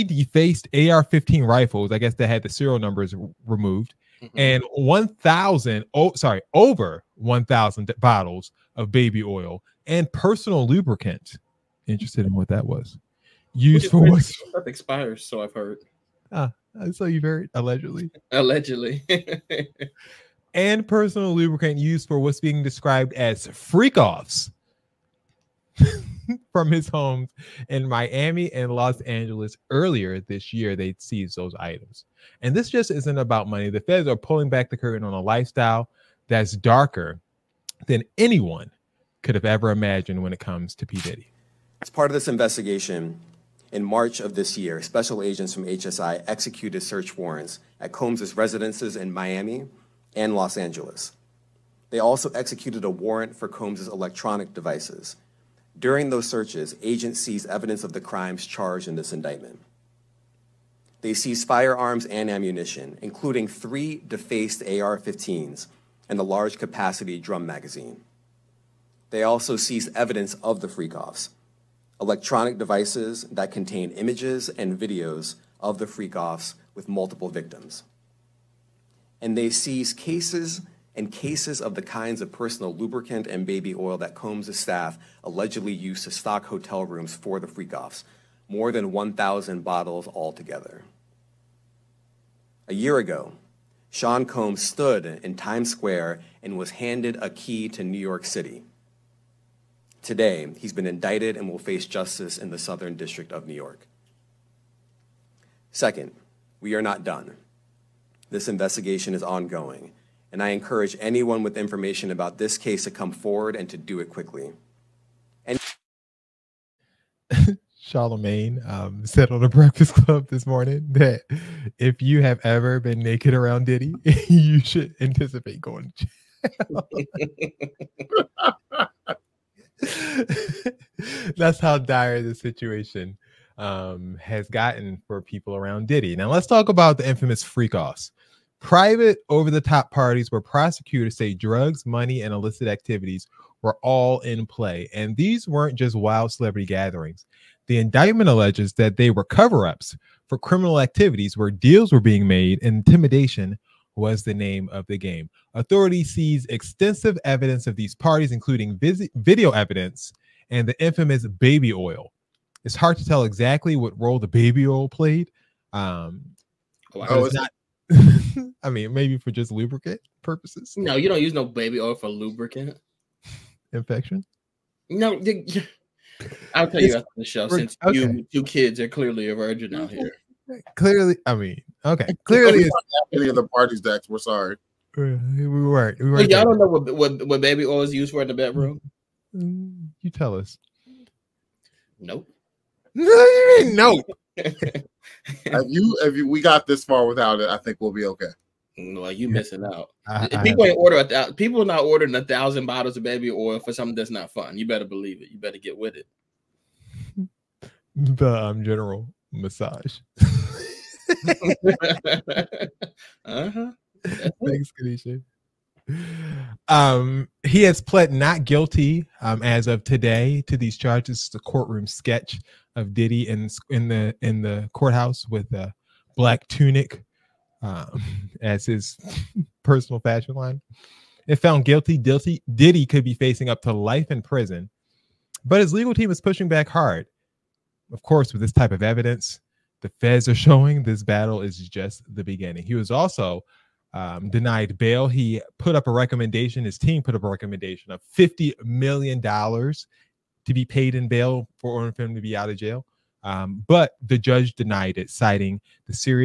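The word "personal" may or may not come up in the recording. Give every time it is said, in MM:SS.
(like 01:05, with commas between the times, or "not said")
00:10, 00:20, 01:22, 03:49.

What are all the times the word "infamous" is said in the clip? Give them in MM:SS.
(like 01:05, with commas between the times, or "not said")
02:17, 02:40.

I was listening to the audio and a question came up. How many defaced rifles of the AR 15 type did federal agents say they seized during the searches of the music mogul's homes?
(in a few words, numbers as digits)
3.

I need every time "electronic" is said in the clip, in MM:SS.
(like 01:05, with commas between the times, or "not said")
00:53, 01:11.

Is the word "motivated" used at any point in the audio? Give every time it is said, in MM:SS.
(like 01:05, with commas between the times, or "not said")
not said.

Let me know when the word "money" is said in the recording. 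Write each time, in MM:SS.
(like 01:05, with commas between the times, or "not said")
00:33, 02:21.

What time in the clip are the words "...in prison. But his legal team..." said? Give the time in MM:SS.
03:54.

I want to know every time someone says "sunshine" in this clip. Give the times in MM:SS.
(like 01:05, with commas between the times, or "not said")
not said.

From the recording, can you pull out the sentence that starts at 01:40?
Today, he's been indicted and will face justice in the Southern District of New York.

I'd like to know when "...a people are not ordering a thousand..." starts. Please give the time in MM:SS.
03:21.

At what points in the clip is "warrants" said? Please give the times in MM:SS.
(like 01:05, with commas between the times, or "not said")
00:47, 00:52.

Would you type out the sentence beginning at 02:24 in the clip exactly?
And these weren't just wild celebrity gatherings.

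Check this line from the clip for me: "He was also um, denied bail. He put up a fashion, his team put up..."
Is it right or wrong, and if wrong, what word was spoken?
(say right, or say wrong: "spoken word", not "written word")
wrong: "recommendation", not "fashion".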